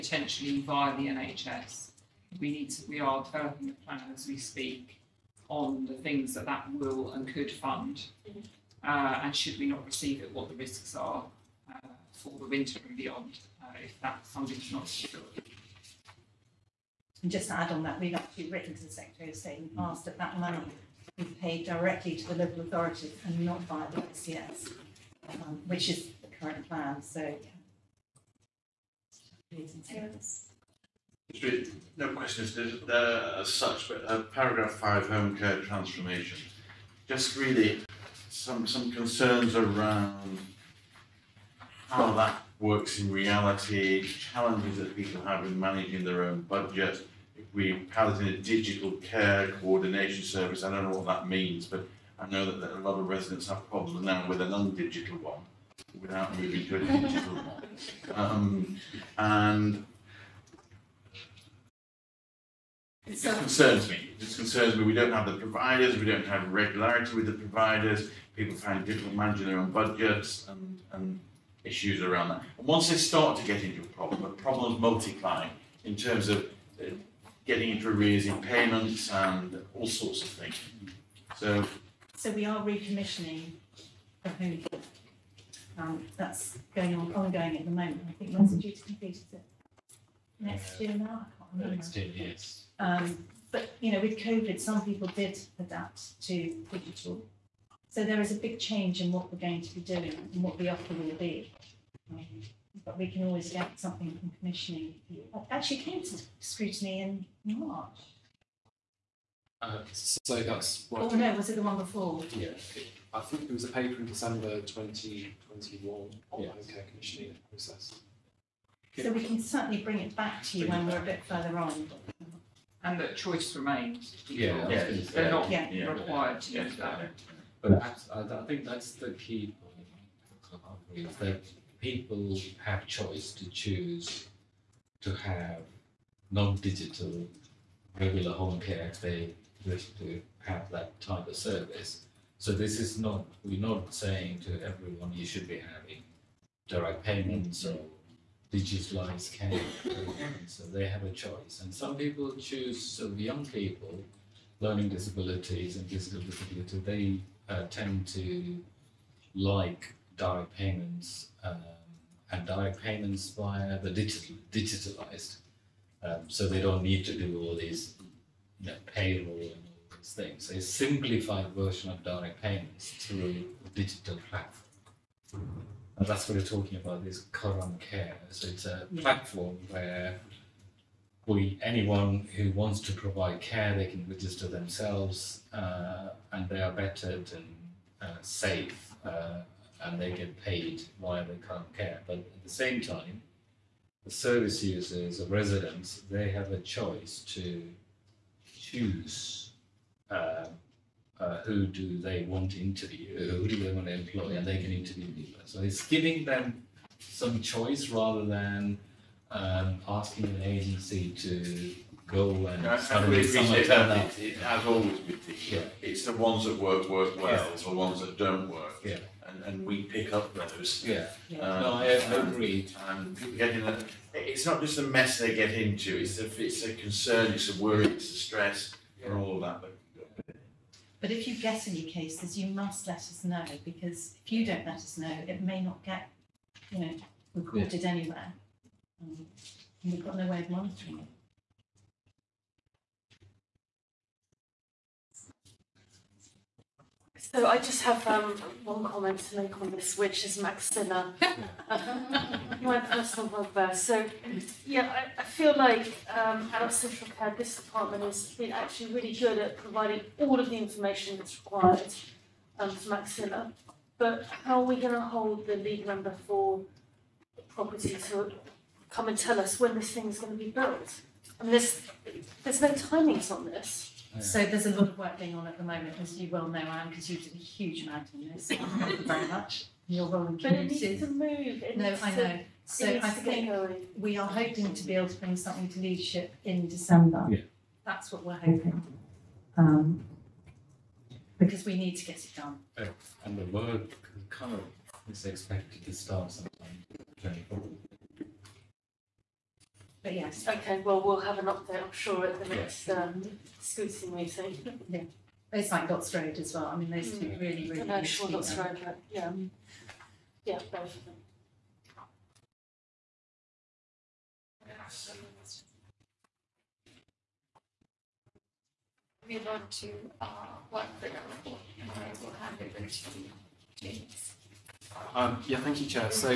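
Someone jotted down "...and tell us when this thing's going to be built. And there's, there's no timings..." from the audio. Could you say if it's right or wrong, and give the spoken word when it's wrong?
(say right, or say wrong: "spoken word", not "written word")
right.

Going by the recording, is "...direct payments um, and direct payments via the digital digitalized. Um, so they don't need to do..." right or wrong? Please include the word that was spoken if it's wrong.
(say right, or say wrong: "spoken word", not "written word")
right.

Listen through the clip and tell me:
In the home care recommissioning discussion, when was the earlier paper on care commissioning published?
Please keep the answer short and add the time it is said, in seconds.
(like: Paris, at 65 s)
December 2021, at 114 s.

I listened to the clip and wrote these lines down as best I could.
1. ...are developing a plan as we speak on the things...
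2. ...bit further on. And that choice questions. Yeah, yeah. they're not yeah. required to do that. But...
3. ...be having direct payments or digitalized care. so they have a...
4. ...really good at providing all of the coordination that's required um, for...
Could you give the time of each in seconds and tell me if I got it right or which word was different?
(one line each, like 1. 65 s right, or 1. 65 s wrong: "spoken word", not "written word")
1. 3 s right
2. 121 s wrong: "remains", not "questions"
3. 145 s right
4. 258 s wrong: "information", not "coordination".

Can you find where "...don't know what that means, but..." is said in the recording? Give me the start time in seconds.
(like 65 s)
50 s.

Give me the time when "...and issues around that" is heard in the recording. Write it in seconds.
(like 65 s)
70 s.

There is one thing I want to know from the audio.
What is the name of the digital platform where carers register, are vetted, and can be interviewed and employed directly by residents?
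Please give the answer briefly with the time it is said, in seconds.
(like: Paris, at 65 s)
Karan Care, at 177 s.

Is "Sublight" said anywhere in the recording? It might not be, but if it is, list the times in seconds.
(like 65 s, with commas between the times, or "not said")
not said.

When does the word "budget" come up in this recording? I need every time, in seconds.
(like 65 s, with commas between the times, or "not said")
46 s, 69 s.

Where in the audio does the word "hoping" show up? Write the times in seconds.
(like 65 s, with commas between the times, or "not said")
284 s, 288 s.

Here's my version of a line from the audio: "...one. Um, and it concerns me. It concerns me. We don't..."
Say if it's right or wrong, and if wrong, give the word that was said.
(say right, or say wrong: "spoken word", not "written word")
right.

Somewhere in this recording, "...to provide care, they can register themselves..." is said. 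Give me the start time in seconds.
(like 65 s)
182 s.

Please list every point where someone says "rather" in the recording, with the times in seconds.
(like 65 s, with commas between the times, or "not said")
207 s.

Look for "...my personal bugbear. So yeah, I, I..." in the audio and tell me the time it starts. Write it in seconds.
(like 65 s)
252 s.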